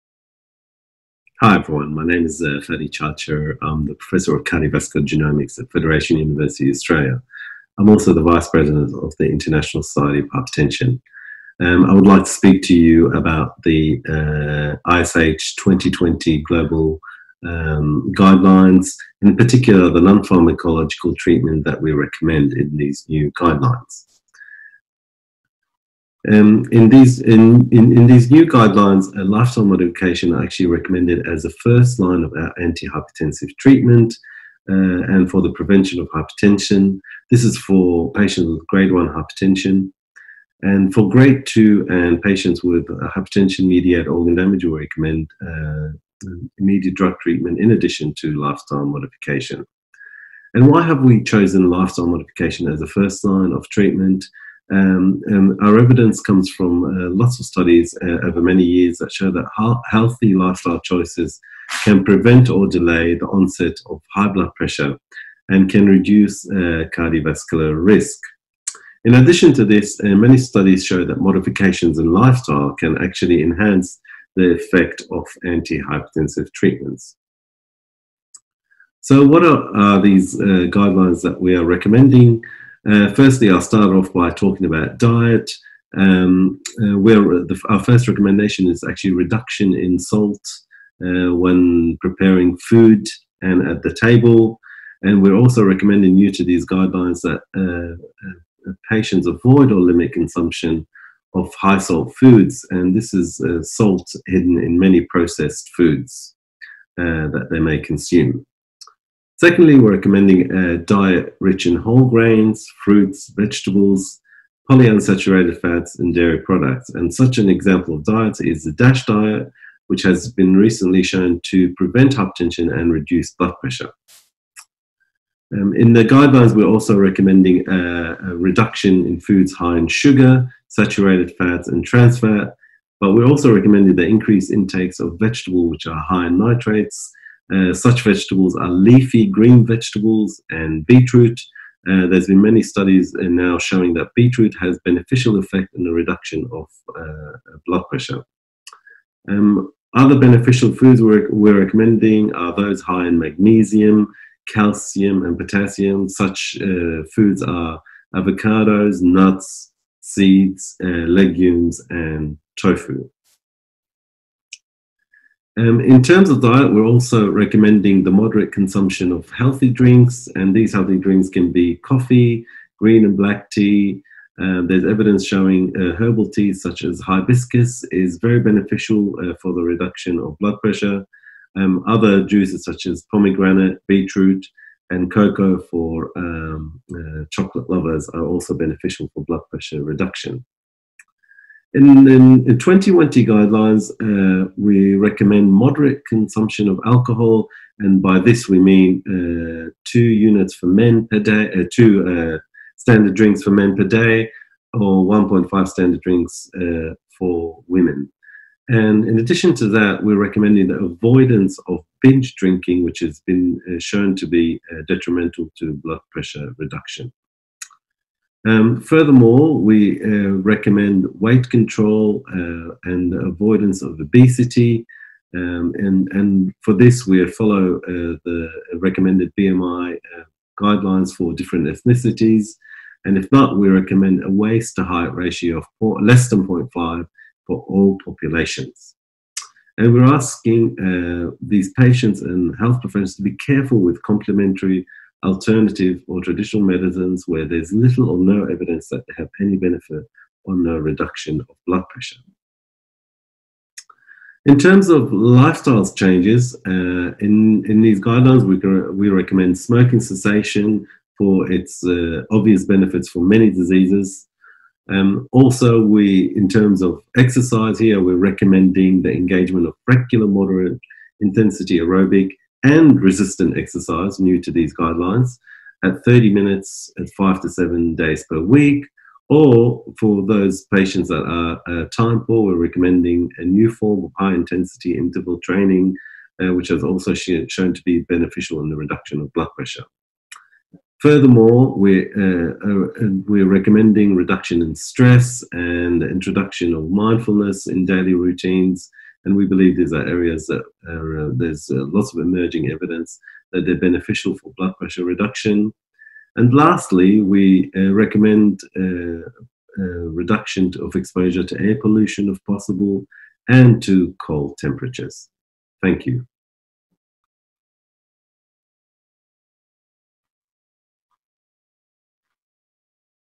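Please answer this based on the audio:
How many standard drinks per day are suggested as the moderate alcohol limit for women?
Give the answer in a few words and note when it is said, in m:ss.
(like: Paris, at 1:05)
1.5, at 3:25.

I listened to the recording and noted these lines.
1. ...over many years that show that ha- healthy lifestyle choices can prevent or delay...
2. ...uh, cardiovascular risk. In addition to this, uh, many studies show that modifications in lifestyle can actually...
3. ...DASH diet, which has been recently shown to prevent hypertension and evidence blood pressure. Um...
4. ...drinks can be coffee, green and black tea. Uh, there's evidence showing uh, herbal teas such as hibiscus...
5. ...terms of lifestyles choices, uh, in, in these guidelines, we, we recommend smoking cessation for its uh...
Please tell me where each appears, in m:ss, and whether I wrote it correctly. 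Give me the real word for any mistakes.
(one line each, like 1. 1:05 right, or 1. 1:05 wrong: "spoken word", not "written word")
1. 0:58 right
2. 1:06 right
3. 1:58 wrong: "reduce", not "evidence"
4. 2:50 right
5. 4:14 wrong: "changes", not "choices".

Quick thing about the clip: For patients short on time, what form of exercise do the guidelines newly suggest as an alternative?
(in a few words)
high intensity interval training.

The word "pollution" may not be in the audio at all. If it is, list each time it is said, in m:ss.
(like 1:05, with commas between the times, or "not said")
5:11.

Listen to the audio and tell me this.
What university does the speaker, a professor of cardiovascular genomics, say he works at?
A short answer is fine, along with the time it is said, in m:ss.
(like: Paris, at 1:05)
Federation University Australia, at 0:05.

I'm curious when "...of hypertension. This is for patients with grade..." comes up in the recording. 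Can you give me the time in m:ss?
0:35.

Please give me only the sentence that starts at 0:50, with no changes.
And why have we chosen lifestyle modification as a first line of treatment?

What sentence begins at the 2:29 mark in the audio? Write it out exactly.
Um, other beneficial foods we're, we're, recommending are those high in magnesium, calcium, and potassium.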